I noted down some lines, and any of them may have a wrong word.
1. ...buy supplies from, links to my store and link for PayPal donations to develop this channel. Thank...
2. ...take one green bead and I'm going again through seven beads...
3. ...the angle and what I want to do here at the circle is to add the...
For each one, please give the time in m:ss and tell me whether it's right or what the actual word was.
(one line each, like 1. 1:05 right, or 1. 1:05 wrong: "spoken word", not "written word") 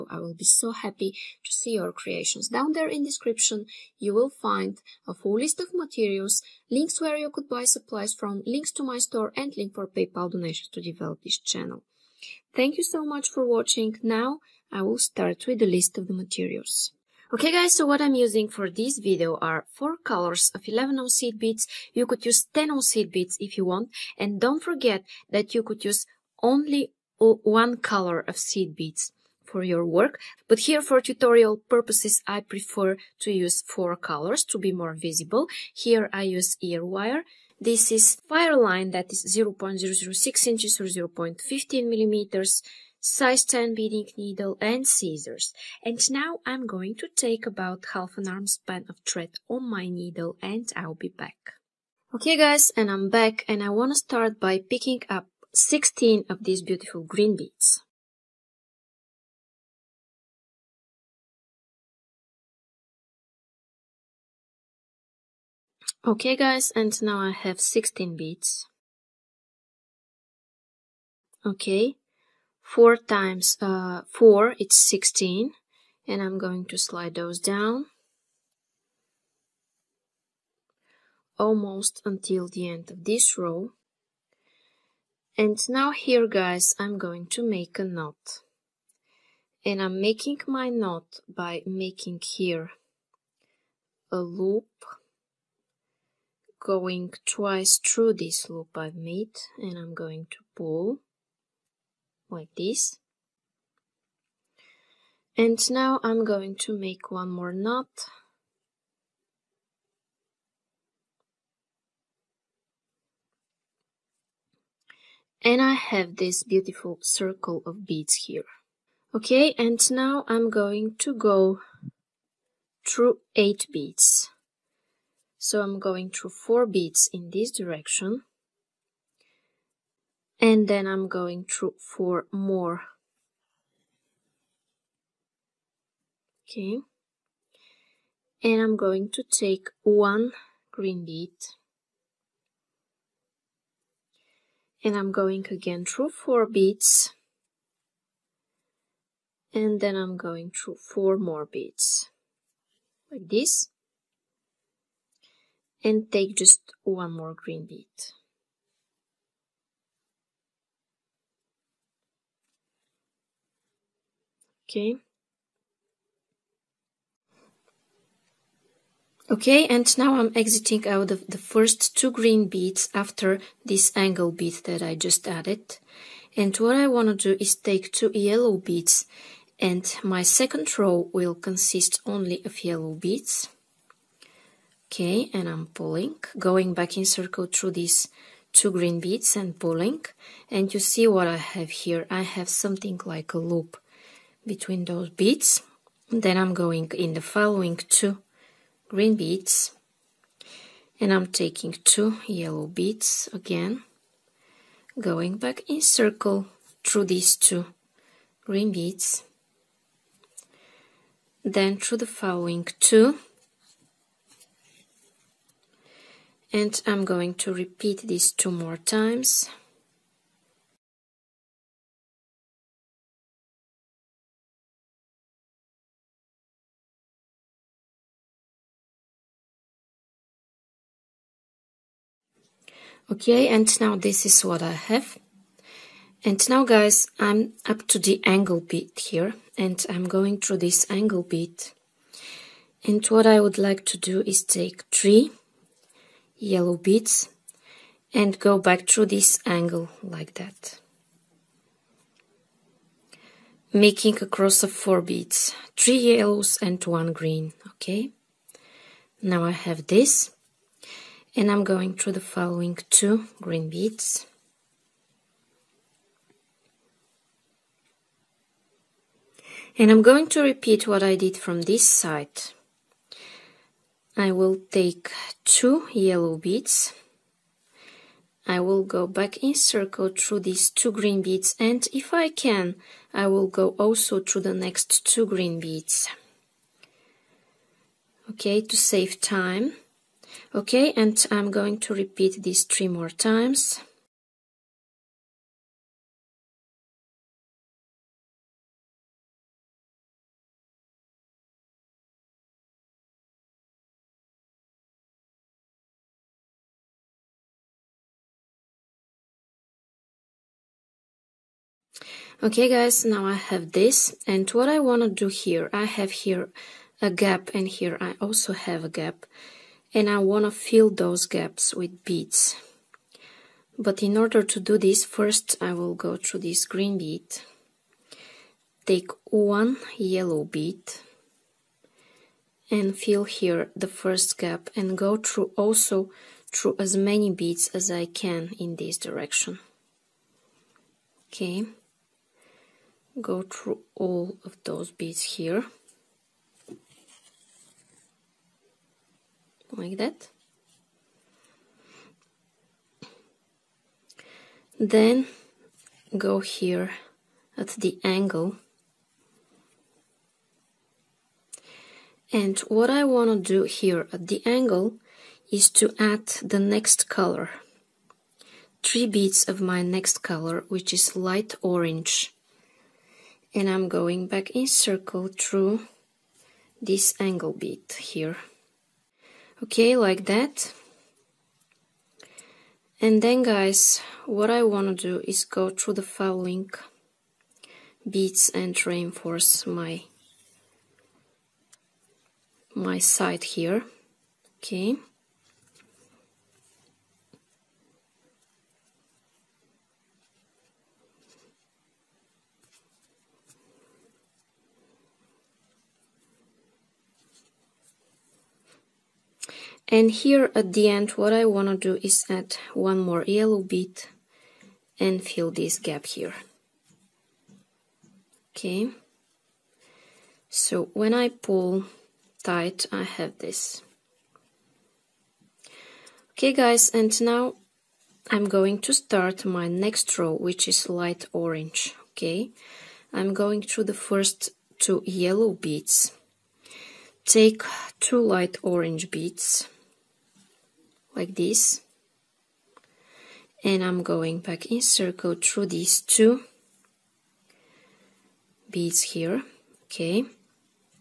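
1. 0:07 right
2. 2:19 wrong: "four", not "seven"
3. 5:57 wrong: "angle", not "circle".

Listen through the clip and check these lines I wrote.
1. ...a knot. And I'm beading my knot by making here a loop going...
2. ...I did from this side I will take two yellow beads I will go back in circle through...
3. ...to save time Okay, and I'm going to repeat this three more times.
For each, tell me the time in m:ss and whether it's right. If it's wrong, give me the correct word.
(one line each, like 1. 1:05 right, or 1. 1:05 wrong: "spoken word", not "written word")
1. 1:27 wrong: "making", not "beading"
2. 4:31 right
3. 4:48 right.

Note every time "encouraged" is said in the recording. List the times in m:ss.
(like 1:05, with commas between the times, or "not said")
not said.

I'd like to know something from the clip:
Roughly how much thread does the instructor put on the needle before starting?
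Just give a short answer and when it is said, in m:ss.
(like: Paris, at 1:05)
Half an arm span, at 0:47.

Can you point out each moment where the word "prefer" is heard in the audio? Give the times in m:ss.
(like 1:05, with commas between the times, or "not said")
0:32.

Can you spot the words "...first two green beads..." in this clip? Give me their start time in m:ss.
2:51.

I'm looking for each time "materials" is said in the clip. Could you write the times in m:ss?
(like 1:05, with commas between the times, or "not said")
0:05, 0:16.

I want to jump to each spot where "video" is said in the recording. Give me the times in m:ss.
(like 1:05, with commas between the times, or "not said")
0:18.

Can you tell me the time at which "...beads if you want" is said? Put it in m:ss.
0:23.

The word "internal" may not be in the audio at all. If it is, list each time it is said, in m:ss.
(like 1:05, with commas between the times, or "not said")
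not said.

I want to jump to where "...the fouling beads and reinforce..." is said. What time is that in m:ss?
6:25.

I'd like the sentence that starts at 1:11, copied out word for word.
Okay, 4 times uh, 4, it's 16.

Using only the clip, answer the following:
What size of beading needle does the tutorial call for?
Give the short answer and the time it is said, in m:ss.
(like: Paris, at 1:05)
Size 10, at 0:43.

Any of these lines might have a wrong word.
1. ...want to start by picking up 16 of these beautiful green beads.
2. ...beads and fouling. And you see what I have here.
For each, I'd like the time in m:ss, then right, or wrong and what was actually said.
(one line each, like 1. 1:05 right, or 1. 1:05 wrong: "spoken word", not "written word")
1. 0:53 right
2. 3:08 wrong: "pulling", not "fouling".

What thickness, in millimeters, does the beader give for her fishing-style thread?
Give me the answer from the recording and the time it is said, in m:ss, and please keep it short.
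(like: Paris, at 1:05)
0.15 millimeters, at 0:40.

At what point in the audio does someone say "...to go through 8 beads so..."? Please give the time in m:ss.
2:00.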